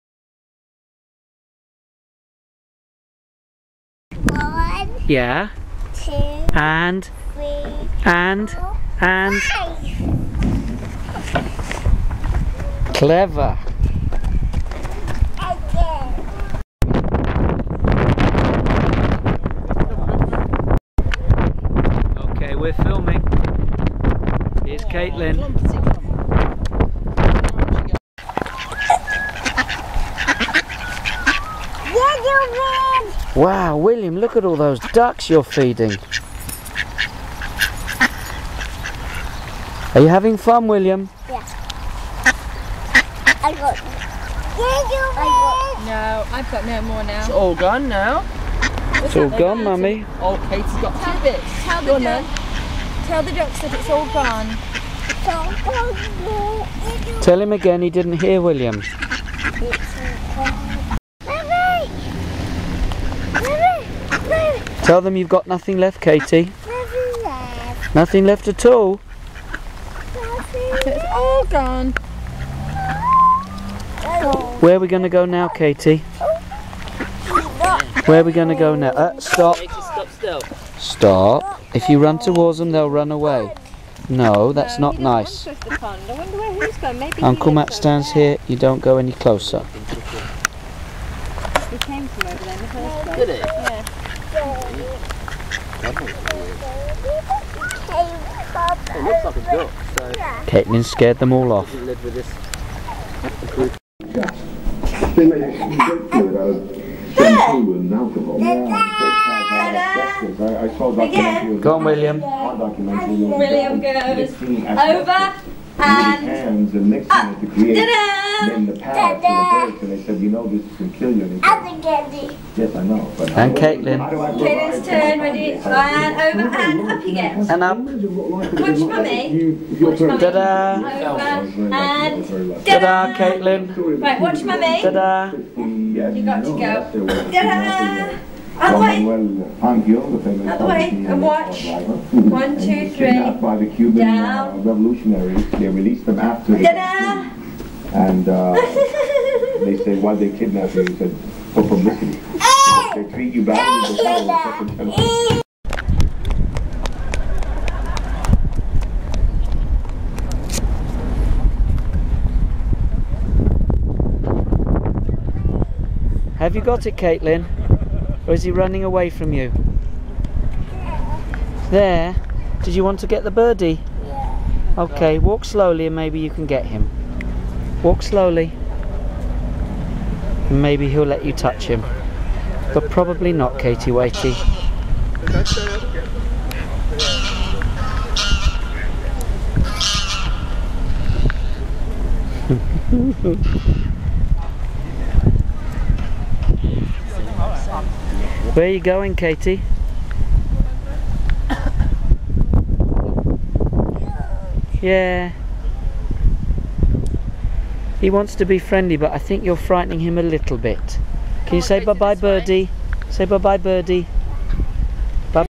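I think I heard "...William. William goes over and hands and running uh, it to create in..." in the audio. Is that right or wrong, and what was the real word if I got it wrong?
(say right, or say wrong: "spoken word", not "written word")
wrong: "mixing", not "running".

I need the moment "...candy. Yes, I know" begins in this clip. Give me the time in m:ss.
2:01.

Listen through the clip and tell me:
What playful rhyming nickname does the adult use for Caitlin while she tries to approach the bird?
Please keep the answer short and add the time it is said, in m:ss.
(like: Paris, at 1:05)
Katie Waity, at 3:03.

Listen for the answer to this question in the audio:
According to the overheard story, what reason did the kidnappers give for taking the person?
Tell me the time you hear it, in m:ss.
2:31.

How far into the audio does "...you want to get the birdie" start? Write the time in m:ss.
2:52.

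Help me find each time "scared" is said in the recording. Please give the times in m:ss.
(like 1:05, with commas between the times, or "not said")
1:40.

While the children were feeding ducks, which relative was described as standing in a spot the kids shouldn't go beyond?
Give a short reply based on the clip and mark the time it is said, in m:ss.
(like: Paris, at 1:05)
Uncle Matt, at 1:27.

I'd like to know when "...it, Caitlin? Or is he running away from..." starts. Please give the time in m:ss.
2:46.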